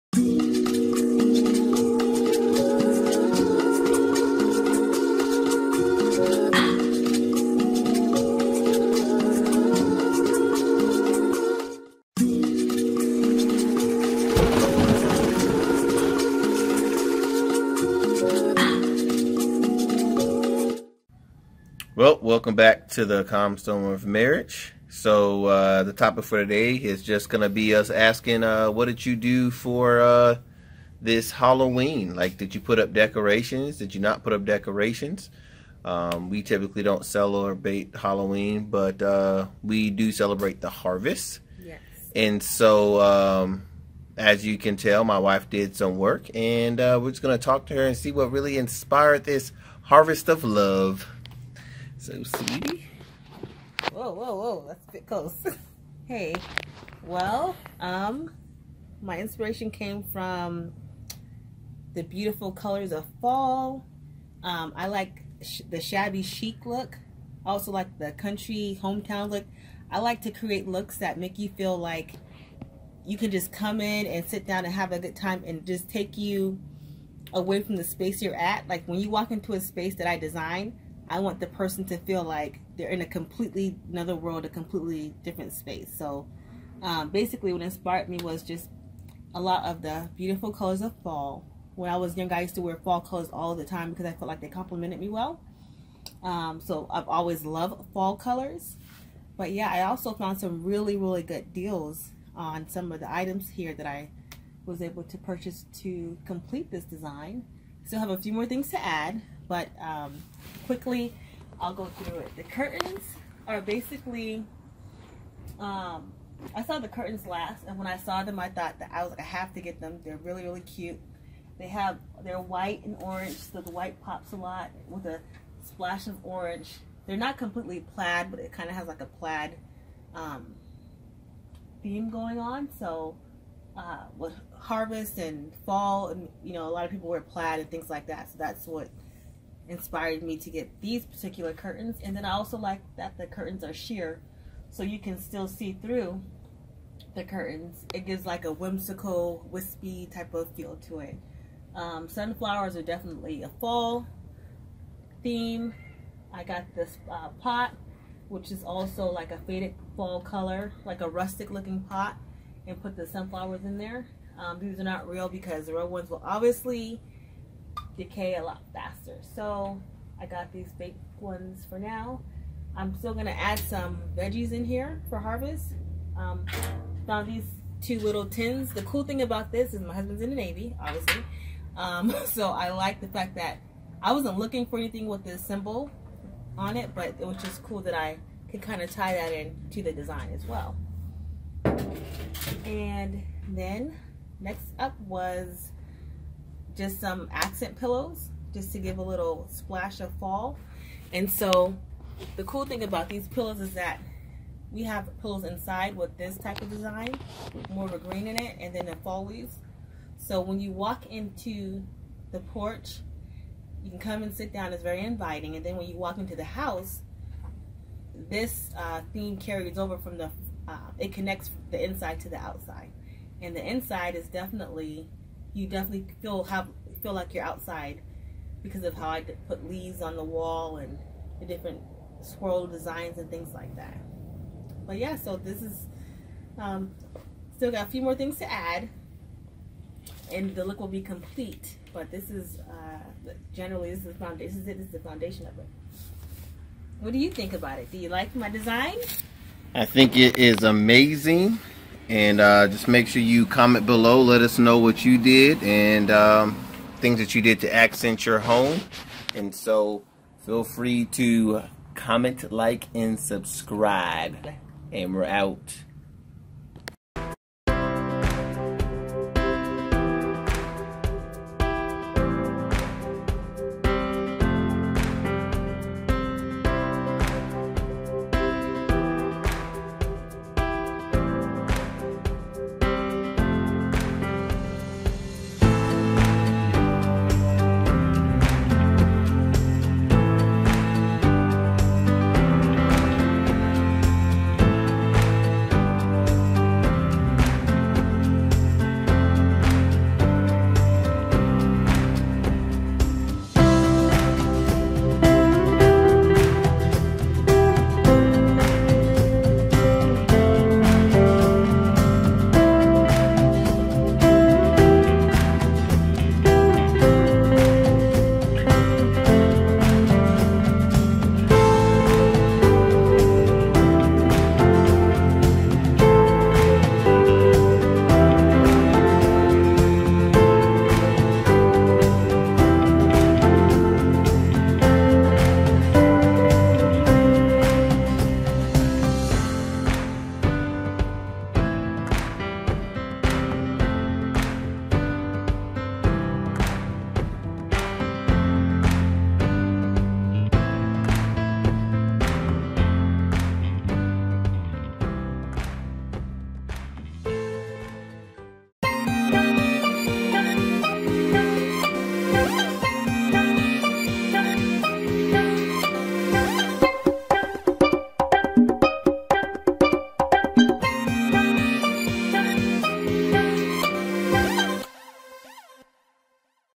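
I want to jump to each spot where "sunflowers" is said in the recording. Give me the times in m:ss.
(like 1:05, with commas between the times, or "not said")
2:32, 2:43.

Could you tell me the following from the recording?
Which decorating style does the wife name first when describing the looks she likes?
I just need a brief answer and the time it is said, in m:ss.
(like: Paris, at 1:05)
Shabby chic, at 1:05.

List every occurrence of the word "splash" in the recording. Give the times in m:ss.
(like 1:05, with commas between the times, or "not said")
2:05, 3:19.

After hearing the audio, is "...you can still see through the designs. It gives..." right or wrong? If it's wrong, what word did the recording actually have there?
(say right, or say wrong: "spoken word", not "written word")
wrong: "curtains", not "designs".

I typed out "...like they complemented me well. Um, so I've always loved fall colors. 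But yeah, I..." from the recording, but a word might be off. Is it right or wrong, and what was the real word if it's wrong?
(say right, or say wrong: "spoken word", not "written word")
right.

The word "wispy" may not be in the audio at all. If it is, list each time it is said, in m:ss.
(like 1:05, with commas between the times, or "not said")
2:29.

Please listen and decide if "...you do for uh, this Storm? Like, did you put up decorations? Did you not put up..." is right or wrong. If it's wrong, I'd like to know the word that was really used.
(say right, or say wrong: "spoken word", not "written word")
wrong: "Halloween", not "Storm".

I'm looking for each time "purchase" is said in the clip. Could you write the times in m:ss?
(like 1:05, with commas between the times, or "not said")
1:45.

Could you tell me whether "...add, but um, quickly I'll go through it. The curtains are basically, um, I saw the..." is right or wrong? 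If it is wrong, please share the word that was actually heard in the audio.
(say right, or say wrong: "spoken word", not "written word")
right.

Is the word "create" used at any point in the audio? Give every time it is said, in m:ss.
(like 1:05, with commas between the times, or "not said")
1:10.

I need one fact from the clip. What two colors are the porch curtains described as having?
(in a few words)
White and orange.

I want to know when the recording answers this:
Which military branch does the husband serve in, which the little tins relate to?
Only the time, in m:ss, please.
3:00.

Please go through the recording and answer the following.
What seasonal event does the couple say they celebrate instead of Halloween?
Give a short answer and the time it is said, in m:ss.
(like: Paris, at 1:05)
The harvest, at 0:40.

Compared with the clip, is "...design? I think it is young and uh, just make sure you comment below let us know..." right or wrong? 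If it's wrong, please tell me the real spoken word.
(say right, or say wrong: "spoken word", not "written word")
wrong: "amazing", not "young".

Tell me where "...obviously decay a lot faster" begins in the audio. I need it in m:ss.
2:46.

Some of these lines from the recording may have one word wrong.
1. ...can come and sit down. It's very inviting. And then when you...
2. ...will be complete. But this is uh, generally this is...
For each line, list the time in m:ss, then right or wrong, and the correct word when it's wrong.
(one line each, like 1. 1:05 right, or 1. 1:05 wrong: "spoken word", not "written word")
1. 3:33 right
2. 4:00 right.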